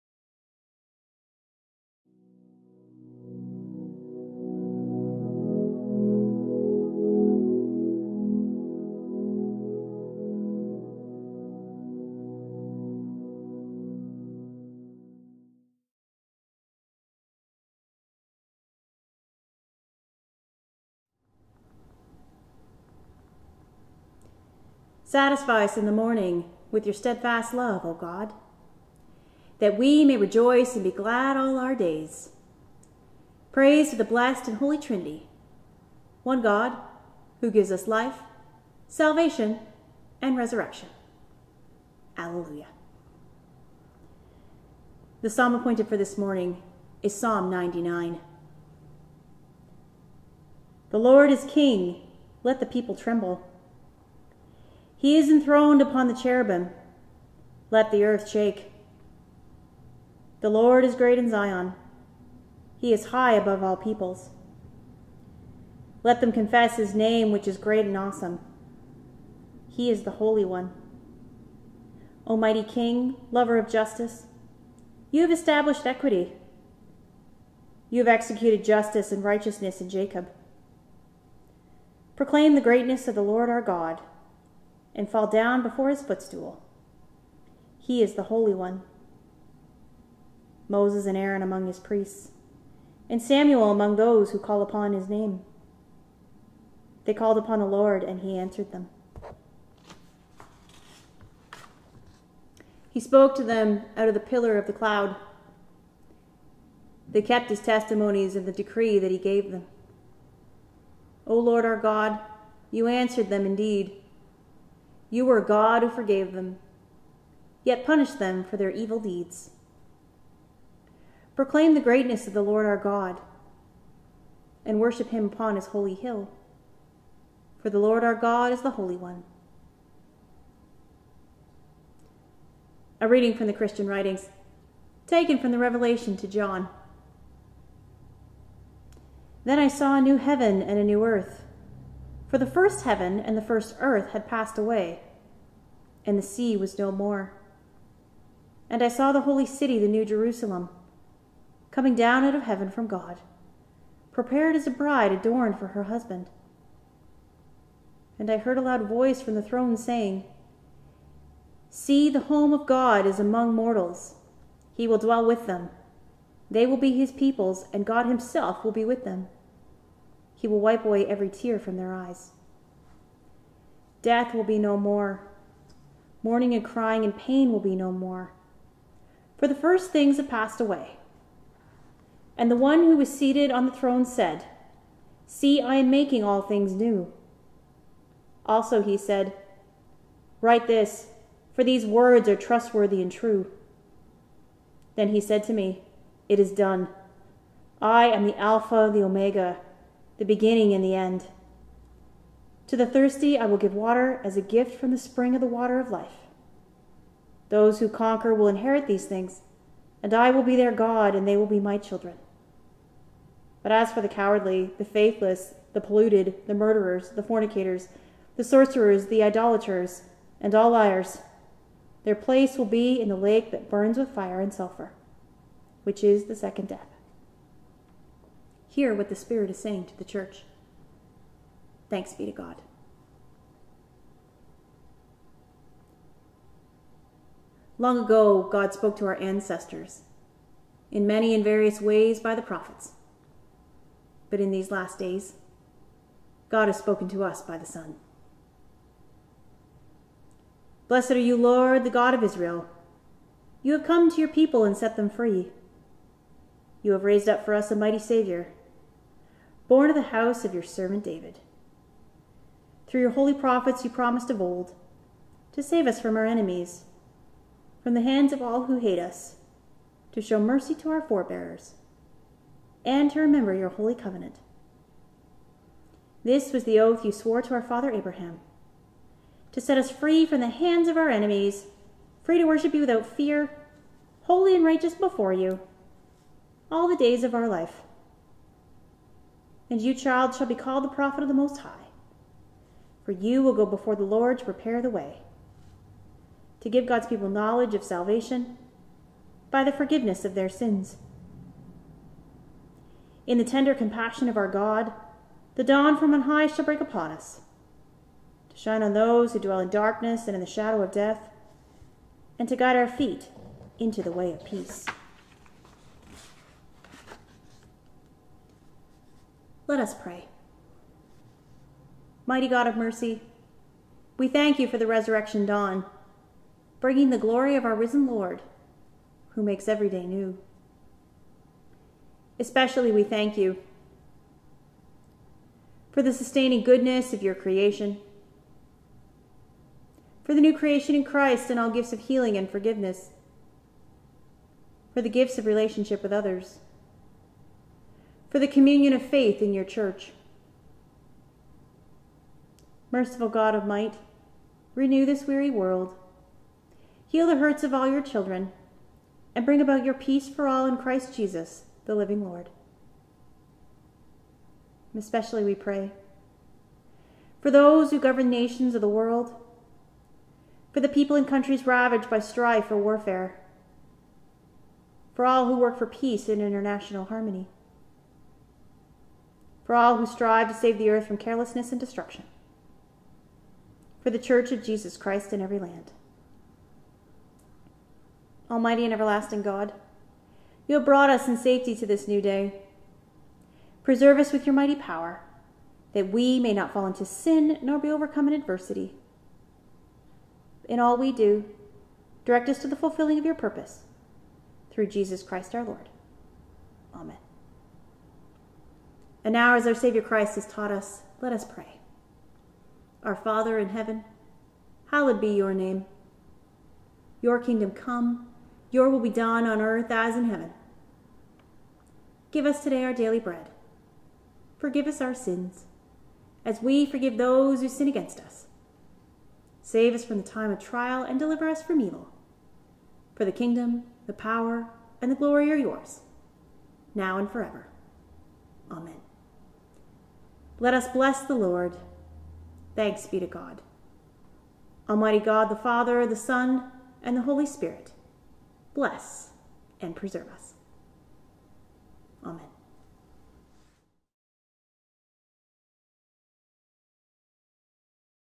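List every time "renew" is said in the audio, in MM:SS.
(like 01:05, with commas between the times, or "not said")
05:54.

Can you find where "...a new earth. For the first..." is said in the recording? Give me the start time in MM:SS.
02:20.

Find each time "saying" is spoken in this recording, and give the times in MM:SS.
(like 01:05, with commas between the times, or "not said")
02:39, 03:49.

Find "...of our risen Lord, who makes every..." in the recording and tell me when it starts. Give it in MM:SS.
05:27.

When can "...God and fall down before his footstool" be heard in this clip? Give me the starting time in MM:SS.
01:23.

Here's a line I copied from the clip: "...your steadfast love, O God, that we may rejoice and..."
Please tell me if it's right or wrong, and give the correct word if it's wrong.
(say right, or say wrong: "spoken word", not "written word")
right.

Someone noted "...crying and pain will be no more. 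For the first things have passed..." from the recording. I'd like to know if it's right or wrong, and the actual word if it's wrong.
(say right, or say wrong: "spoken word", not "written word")
right.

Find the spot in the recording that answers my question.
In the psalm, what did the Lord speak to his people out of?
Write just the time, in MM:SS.
01:44.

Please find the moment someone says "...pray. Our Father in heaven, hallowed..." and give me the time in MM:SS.
06:51.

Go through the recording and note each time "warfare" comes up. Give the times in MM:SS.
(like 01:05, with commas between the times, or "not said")
06:12.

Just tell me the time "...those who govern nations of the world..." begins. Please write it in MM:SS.
06:07.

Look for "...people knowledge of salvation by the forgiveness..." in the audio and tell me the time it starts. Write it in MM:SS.
04:57.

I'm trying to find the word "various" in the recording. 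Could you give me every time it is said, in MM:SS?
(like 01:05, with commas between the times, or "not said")
04:01.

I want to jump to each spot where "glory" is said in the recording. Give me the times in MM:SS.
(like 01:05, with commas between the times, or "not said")
05:27, 07:15.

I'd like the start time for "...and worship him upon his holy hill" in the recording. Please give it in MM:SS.
02:04.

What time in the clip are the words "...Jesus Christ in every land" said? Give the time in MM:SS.
06:24.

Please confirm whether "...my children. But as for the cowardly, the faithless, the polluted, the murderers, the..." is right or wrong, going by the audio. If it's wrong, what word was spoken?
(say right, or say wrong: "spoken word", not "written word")
right.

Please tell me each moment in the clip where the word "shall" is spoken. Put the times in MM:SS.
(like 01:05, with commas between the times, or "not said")
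04:50, 05:06.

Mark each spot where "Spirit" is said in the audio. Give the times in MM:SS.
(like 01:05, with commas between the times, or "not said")
03:49, 07:27.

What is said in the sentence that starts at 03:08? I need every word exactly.
Also he said, Write this, for these words are trustworthy and true.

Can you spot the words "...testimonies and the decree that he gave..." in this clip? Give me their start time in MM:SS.
01:47.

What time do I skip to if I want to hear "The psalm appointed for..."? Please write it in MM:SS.
00:45.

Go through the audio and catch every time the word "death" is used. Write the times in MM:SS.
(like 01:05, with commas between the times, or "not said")
02:54, 03:46, 05:10.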